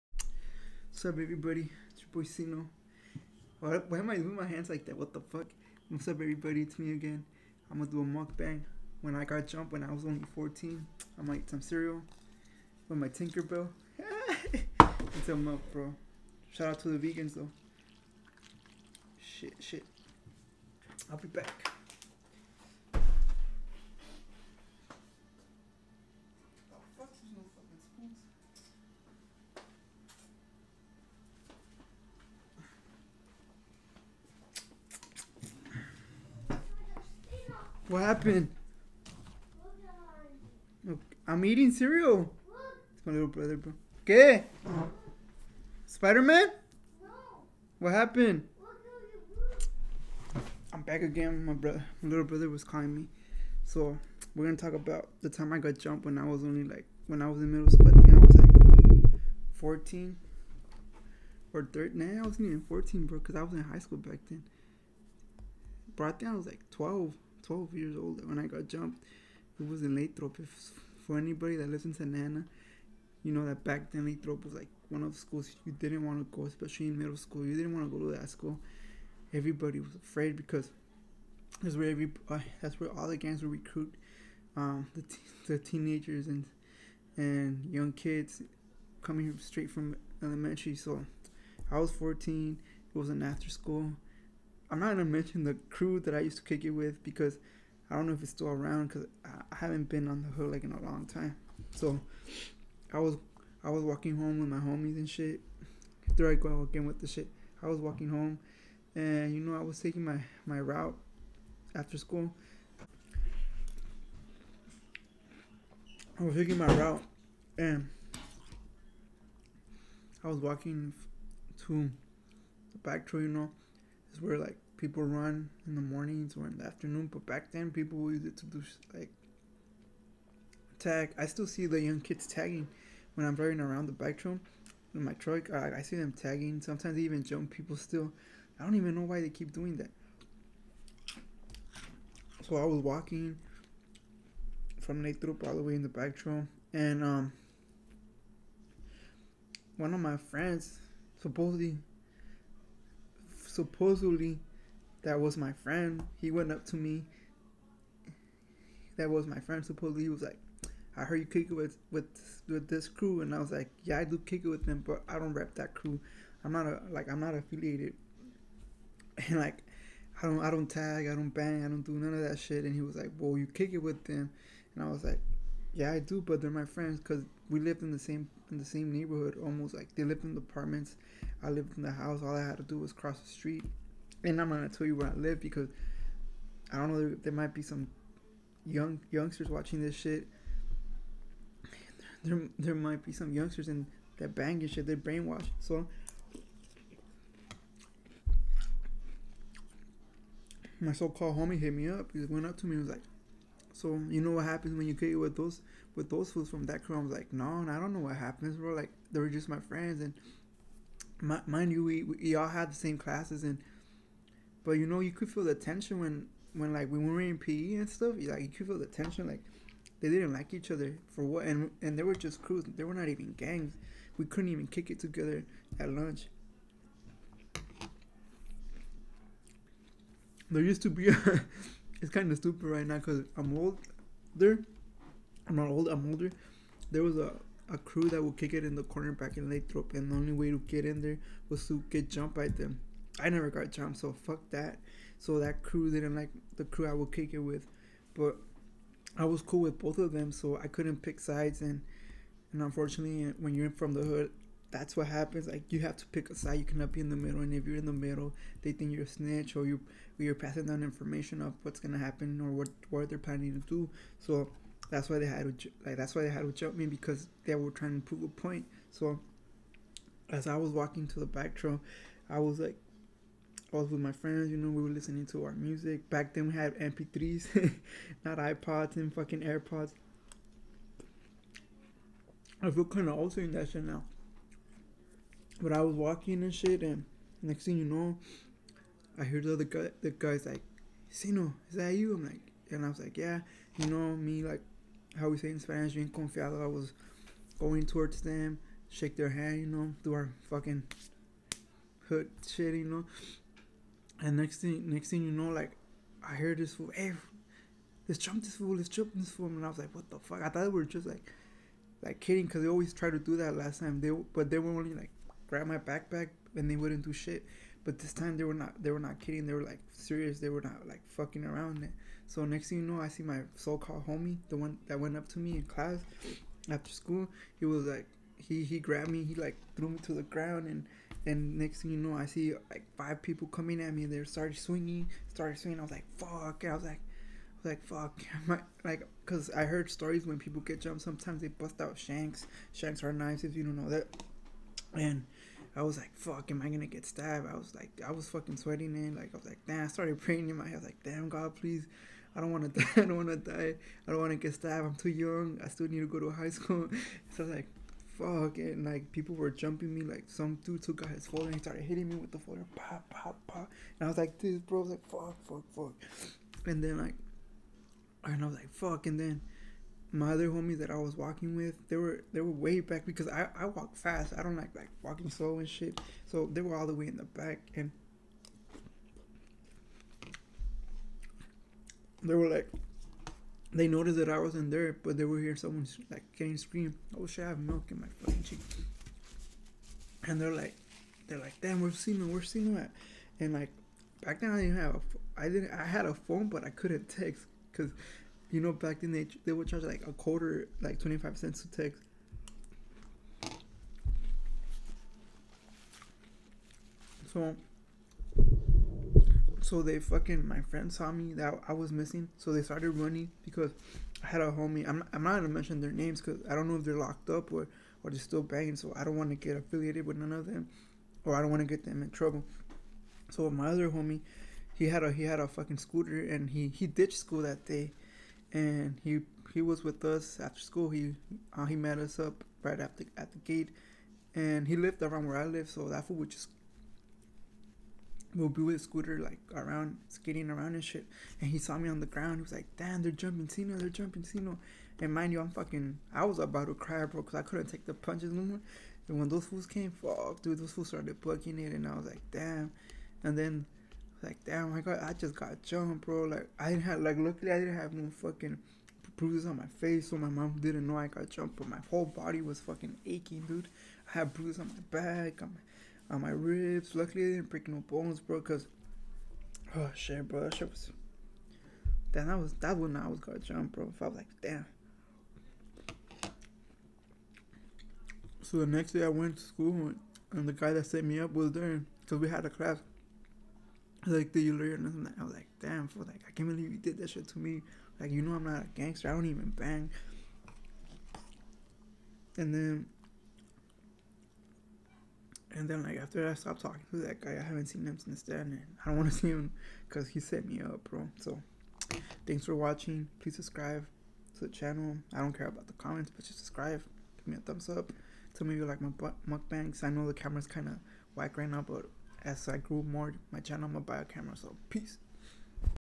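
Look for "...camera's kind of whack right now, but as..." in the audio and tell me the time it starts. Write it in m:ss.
8:30.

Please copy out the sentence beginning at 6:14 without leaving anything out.
I don't like like walking slow and shit.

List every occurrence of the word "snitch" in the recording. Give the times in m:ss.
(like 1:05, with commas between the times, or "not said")
4:19.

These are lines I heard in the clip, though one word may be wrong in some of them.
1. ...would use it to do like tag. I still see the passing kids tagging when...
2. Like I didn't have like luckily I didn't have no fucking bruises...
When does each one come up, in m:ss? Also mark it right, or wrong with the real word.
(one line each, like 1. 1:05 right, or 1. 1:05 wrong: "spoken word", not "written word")
1. 2:07 wrong: "young", not "passing"
2. 7:36 right.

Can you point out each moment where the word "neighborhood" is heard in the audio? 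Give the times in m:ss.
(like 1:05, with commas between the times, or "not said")
2:58.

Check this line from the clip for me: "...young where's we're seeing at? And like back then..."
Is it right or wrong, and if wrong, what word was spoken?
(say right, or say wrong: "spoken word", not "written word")
wrong: "seeing", not "young".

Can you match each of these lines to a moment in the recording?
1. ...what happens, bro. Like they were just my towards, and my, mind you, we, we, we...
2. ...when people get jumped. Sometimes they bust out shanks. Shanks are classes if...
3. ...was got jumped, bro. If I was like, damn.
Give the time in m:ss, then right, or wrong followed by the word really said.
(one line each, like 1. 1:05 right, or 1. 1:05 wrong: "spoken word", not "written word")
1. 3:27 wrong: "friends", not "towards"
2. 5:40 wrong: "knives", not "classes"
3. 7:53 right.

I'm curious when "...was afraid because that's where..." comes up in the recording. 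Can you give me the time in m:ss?
1:19.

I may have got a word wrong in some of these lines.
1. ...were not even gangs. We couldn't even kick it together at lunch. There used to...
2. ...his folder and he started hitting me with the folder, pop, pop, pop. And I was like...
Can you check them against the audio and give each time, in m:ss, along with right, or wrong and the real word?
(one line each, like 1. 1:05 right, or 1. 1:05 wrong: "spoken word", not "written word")
1. 3:42 right
2. 6:01 right.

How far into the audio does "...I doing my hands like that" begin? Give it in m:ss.
0:04.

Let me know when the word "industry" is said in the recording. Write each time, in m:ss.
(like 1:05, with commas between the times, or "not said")
not said.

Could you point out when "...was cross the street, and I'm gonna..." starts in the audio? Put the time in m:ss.
3:02.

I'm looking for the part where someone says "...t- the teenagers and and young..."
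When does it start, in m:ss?
1:25.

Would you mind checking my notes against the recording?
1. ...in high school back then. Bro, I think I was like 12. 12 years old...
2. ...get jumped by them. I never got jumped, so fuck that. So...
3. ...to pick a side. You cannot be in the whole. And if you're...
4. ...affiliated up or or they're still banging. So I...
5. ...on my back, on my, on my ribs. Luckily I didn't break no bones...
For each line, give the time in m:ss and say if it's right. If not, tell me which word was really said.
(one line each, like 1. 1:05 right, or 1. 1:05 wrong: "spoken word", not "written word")
1. 1:03 right
2. 4:01 right
3. 4:15 wrong: "middle", not "whole"
4. 6:56 wrong: "locked", not "affiliated"
5. 7:44 right.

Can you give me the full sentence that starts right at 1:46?
There I go again with the shit.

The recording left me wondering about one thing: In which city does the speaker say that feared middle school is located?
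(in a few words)
Santa Ana.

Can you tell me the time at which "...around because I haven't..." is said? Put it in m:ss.
1:38.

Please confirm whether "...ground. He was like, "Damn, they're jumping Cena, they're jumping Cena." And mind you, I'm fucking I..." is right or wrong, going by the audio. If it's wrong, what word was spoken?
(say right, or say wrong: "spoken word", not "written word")
right.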